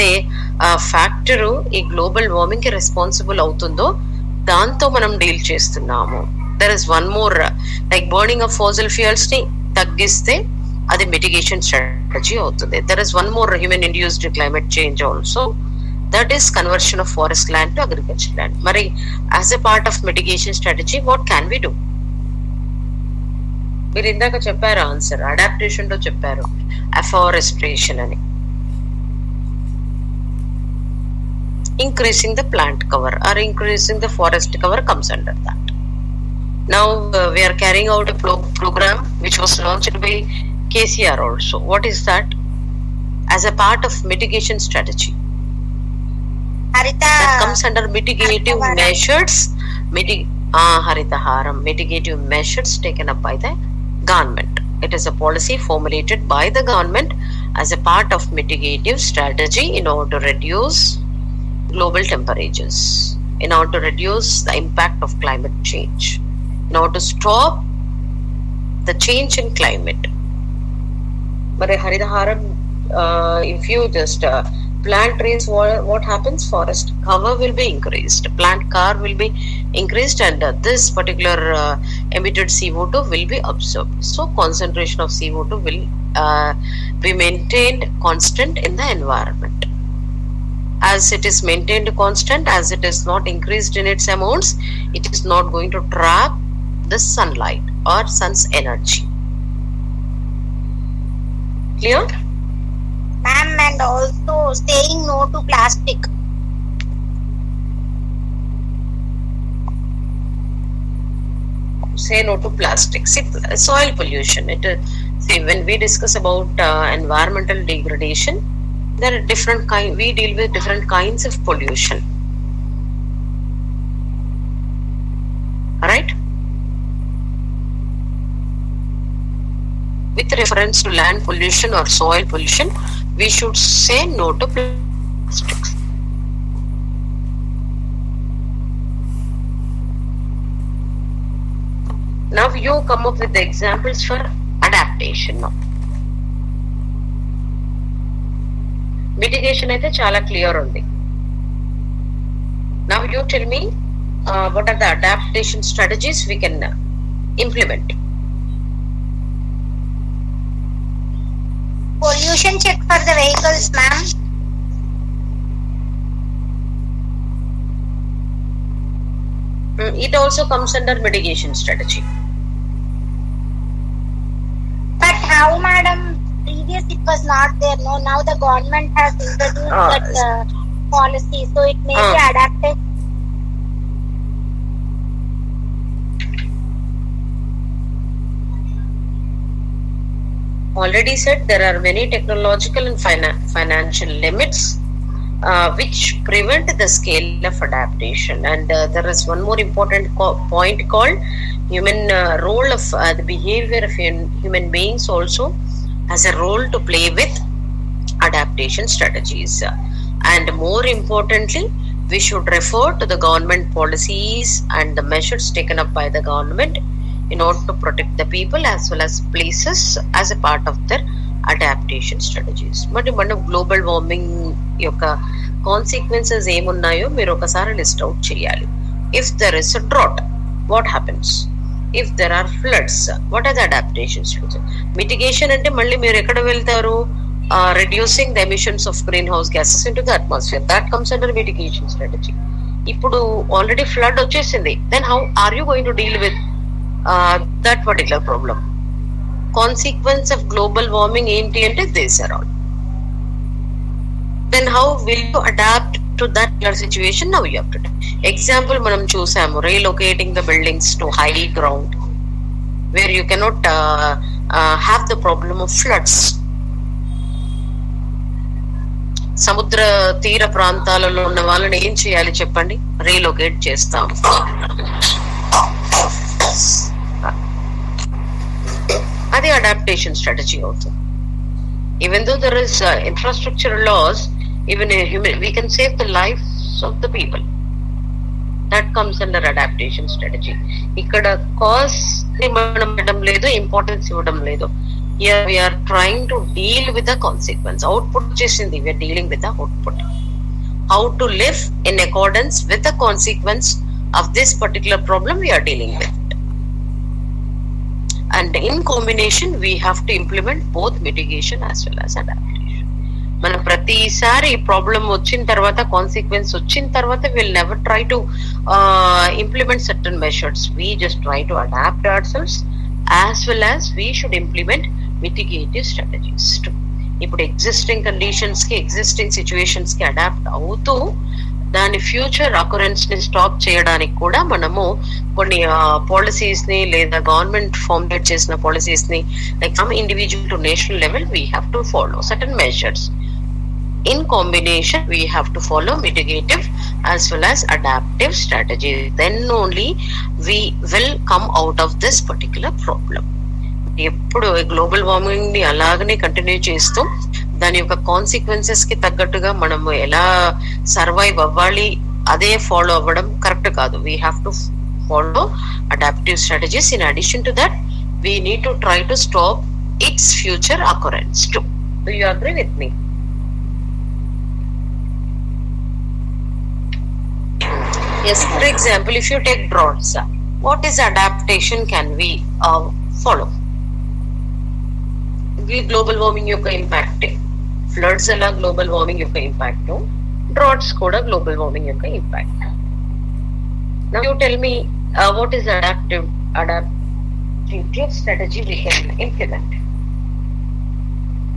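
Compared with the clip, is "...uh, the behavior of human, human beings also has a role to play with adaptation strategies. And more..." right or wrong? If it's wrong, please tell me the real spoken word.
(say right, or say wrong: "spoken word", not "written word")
right.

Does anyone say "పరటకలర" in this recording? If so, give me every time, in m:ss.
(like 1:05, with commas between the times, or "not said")
4:07, 5:04.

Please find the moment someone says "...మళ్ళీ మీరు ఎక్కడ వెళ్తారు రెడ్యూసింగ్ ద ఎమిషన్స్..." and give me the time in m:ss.
3:55.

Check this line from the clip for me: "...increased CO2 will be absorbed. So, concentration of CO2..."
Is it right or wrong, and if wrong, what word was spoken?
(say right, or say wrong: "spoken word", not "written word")
wrong: "emitted", not "increased".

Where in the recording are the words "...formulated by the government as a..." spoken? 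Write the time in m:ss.
0:55.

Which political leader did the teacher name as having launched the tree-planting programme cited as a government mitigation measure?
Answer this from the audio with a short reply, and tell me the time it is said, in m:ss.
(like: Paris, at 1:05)
KCR, at 0:40.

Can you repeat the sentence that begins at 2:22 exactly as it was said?
Now you come up with the examples for adaptation now.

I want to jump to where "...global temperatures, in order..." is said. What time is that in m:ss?
1:01.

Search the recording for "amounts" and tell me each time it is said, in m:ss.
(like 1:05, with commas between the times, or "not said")
1:34.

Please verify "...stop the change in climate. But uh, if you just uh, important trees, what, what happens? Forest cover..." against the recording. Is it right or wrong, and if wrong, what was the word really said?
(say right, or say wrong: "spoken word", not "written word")
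wrong: "plant", not "important".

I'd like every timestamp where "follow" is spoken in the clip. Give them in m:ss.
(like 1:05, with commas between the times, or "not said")
6:05, 6:23.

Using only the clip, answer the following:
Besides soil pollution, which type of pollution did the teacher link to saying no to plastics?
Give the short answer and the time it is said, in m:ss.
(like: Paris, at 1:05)
Land pollution, at 2:10.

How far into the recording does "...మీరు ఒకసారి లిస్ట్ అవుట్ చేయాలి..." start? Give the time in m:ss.
3:47.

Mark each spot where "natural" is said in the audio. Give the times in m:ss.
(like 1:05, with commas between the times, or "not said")
not said.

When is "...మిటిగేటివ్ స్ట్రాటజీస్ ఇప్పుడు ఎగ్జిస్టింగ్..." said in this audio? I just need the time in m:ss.
5:25.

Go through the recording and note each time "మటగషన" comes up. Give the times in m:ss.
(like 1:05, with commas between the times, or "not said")
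0:11, 0:20, 2:29, 3:55, 4:01, 5:11.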